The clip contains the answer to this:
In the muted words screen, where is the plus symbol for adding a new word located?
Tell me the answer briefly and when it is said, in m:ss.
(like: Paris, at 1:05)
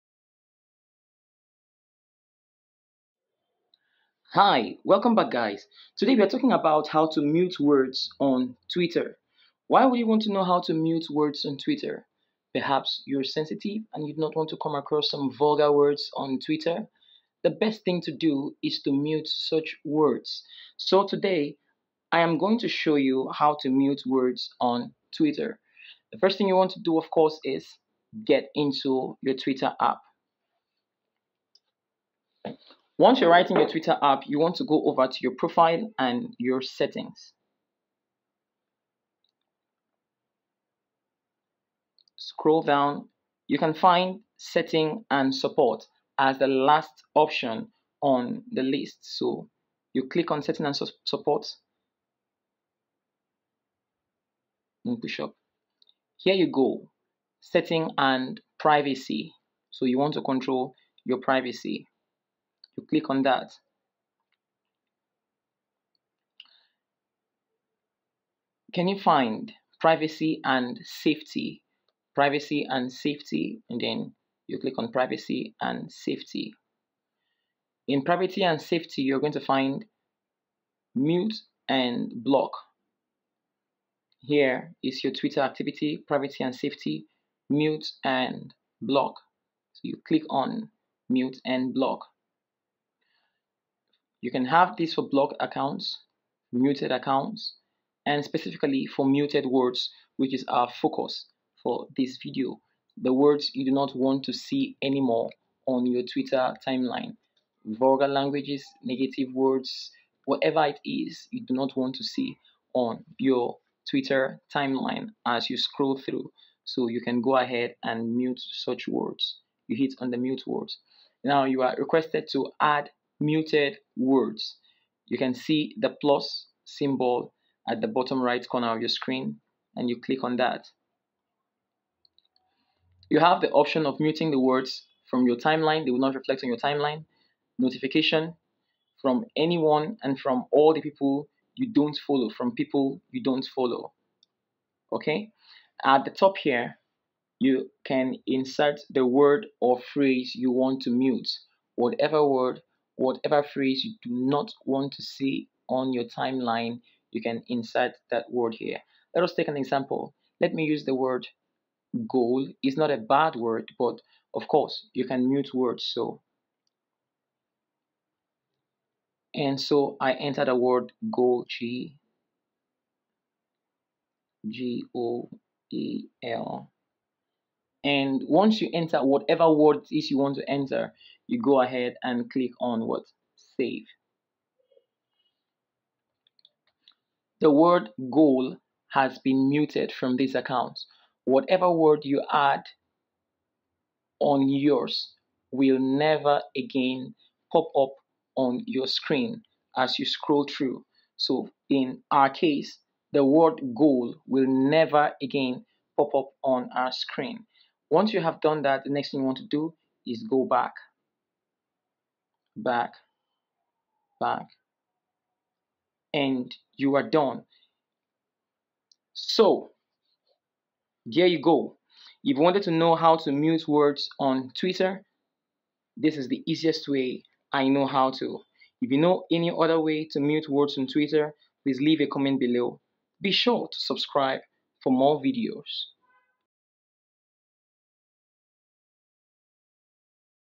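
Bottom right corner, at 2:07.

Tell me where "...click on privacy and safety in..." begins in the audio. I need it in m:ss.
1:14.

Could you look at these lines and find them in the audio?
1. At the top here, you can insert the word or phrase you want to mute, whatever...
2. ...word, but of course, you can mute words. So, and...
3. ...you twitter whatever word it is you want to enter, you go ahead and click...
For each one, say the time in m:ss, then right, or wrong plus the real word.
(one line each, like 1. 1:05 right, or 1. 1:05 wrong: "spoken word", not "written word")
1. 2:25 right
2. 2:43 right
3. 2:58 wrong: "enter", not "twitter".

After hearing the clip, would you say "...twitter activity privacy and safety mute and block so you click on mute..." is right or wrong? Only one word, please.
right.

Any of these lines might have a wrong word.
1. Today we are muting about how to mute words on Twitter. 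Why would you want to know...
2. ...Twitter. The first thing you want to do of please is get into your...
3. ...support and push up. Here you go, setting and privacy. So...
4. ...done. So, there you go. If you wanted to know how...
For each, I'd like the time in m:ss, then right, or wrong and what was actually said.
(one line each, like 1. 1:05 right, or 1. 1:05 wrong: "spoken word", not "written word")
1. 0:05 wrong: "talking", not "muting"
2. 0:25 wrong: "course", not "please"
3. 0:51 right
4. 3:37 right.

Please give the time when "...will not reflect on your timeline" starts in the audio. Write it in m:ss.
2:15.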